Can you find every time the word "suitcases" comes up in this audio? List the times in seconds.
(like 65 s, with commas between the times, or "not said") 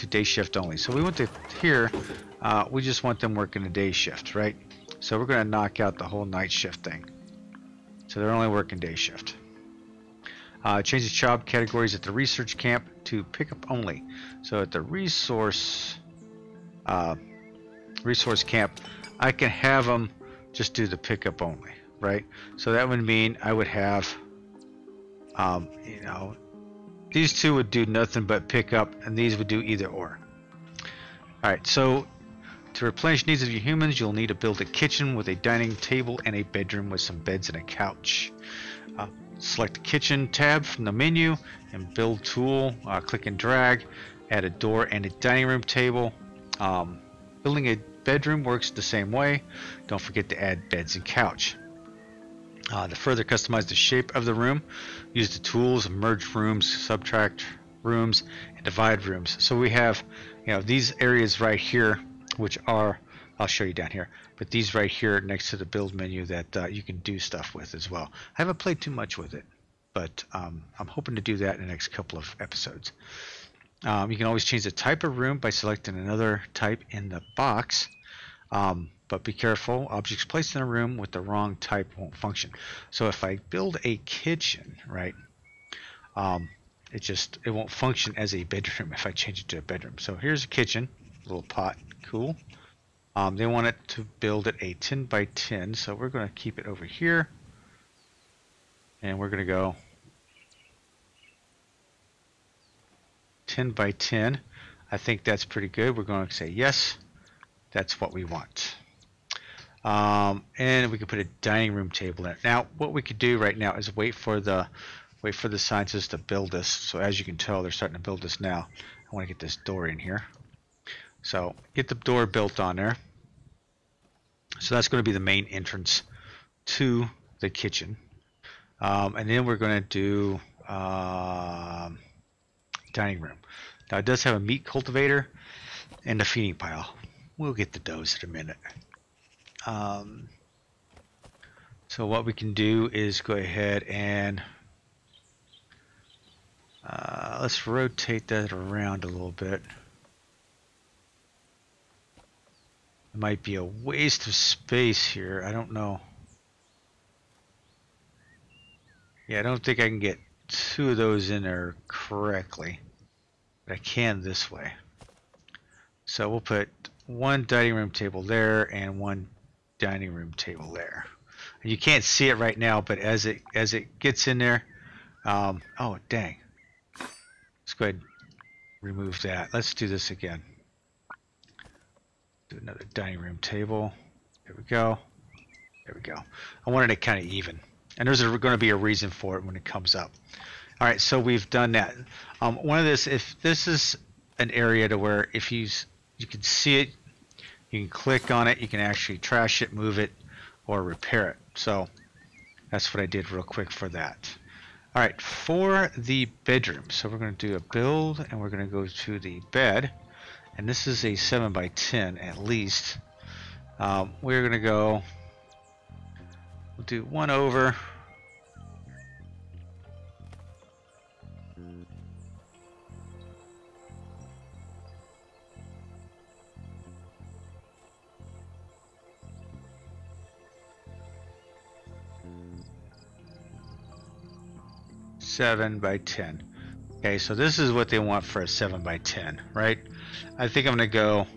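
not said.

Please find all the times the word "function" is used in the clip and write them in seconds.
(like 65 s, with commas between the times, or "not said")
82 s, 87 s.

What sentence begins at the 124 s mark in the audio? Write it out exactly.
So that's going to be the main entrance to the kitchen.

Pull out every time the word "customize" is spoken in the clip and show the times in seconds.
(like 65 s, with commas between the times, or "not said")
53 s.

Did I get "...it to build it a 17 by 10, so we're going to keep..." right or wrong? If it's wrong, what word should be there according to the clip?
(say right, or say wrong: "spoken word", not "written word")
wrong: "10", not "17".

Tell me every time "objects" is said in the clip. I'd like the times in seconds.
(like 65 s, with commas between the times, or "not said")
79 s.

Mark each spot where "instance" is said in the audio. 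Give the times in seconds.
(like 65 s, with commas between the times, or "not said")
not said.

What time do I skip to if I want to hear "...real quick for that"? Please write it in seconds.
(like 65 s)
203 s.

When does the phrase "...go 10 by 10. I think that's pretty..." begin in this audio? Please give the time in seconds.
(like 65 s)
99 s.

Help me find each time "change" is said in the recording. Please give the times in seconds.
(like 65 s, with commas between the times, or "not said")
74 s, 89 s.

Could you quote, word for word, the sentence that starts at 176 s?
Let's go ahead and remove that.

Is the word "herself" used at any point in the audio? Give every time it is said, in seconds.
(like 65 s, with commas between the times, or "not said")
not said.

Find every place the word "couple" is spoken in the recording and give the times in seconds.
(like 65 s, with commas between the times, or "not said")
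71 s.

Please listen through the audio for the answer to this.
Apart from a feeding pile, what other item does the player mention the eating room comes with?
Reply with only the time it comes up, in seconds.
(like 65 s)
134 s.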